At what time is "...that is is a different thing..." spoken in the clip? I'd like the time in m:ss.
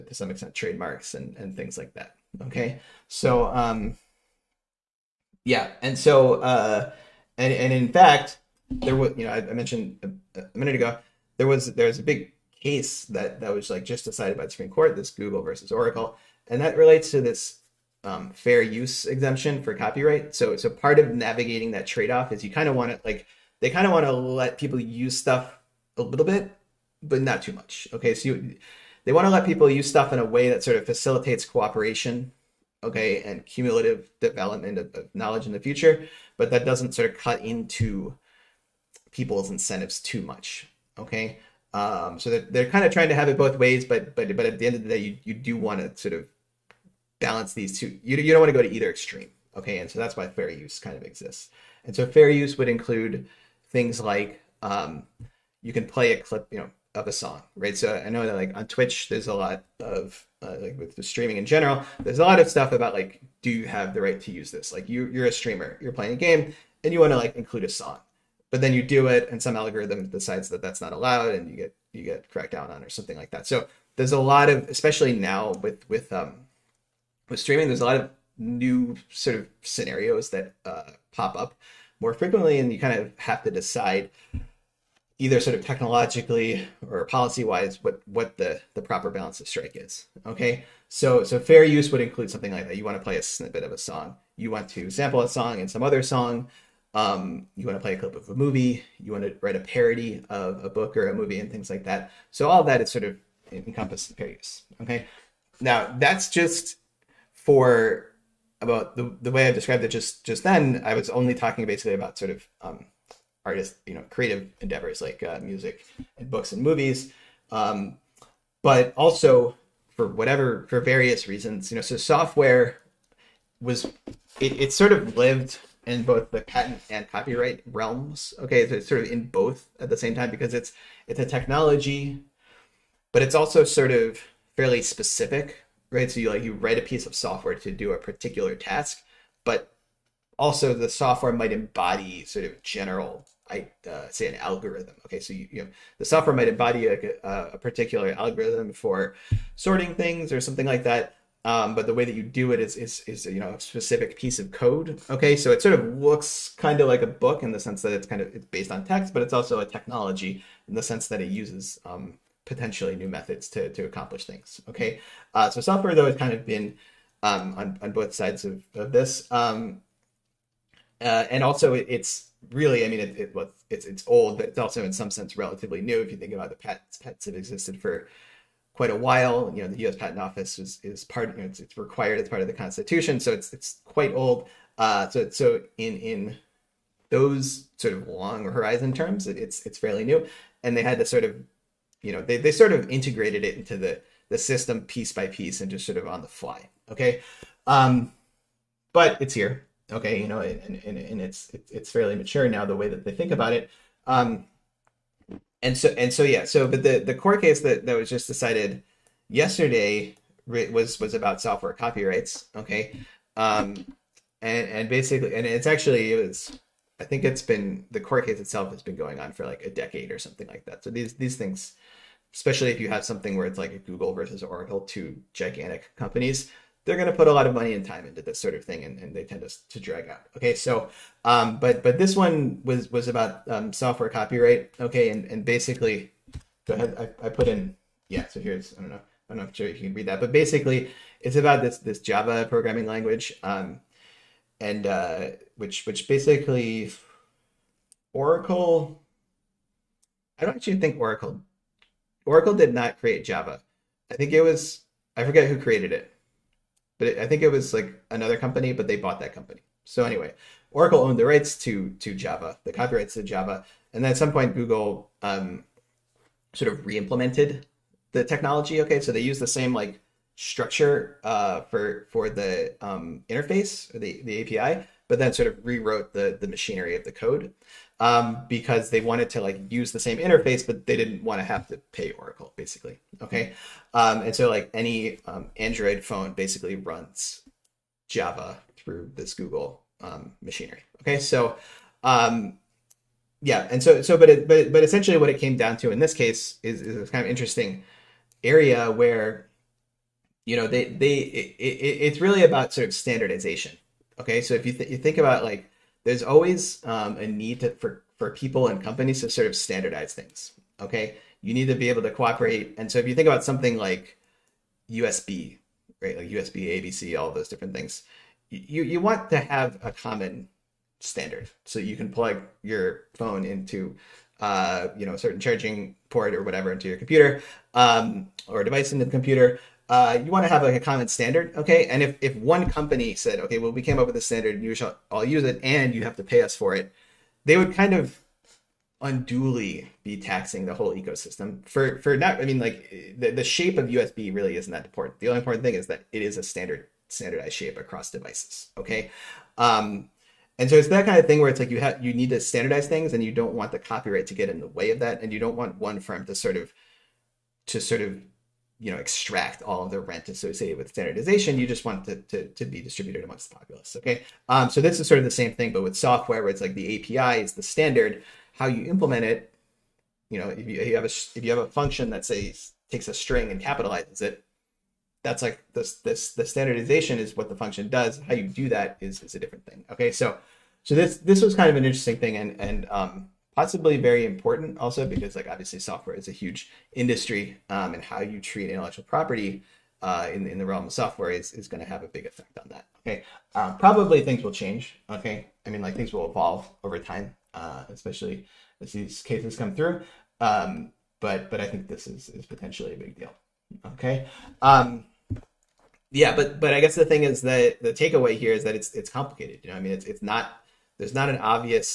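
6:18.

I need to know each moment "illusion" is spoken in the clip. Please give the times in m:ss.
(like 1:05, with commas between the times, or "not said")
not said.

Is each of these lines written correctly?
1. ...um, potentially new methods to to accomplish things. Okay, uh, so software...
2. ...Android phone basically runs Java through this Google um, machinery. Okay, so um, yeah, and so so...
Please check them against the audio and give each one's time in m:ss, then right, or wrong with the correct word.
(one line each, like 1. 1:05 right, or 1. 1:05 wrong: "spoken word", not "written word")
1. 2:41 right
2. 4:45 right.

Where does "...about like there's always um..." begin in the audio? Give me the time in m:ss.
5:05.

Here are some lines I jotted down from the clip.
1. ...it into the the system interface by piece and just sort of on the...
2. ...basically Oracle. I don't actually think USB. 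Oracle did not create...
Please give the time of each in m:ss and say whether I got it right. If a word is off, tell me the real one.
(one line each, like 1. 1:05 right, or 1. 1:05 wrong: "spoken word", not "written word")
1. 3:13 wrong: "piece", not "interface"
2. 4:06 wrong: "Oracle", not "USB".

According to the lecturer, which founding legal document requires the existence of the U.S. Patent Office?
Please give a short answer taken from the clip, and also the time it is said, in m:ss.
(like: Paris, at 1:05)
the Constitution, at 3:02.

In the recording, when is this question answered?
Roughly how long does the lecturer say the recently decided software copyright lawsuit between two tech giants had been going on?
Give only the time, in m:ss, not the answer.
3:39.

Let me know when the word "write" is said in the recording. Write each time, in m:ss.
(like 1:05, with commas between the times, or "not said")
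1:39, 2:16.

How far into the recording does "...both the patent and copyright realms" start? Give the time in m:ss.
2:06.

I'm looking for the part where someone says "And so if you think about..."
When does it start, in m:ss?
5:12.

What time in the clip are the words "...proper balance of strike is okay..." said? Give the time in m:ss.
1:28.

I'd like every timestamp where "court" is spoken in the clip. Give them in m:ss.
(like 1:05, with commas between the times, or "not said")
0:14, 3:27, 3:37.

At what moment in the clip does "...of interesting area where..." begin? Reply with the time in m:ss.
4:57.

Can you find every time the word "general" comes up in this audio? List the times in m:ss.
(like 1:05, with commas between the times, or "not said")
1:01, 2:22.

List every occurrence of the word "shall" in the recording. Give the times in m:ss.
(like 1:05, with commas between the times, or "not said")
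5:34.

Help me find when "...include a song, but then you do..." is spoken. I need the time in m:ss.
1:07.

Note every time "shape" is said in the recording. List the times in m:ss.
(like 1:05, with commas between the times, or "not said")
5:43, 5:47.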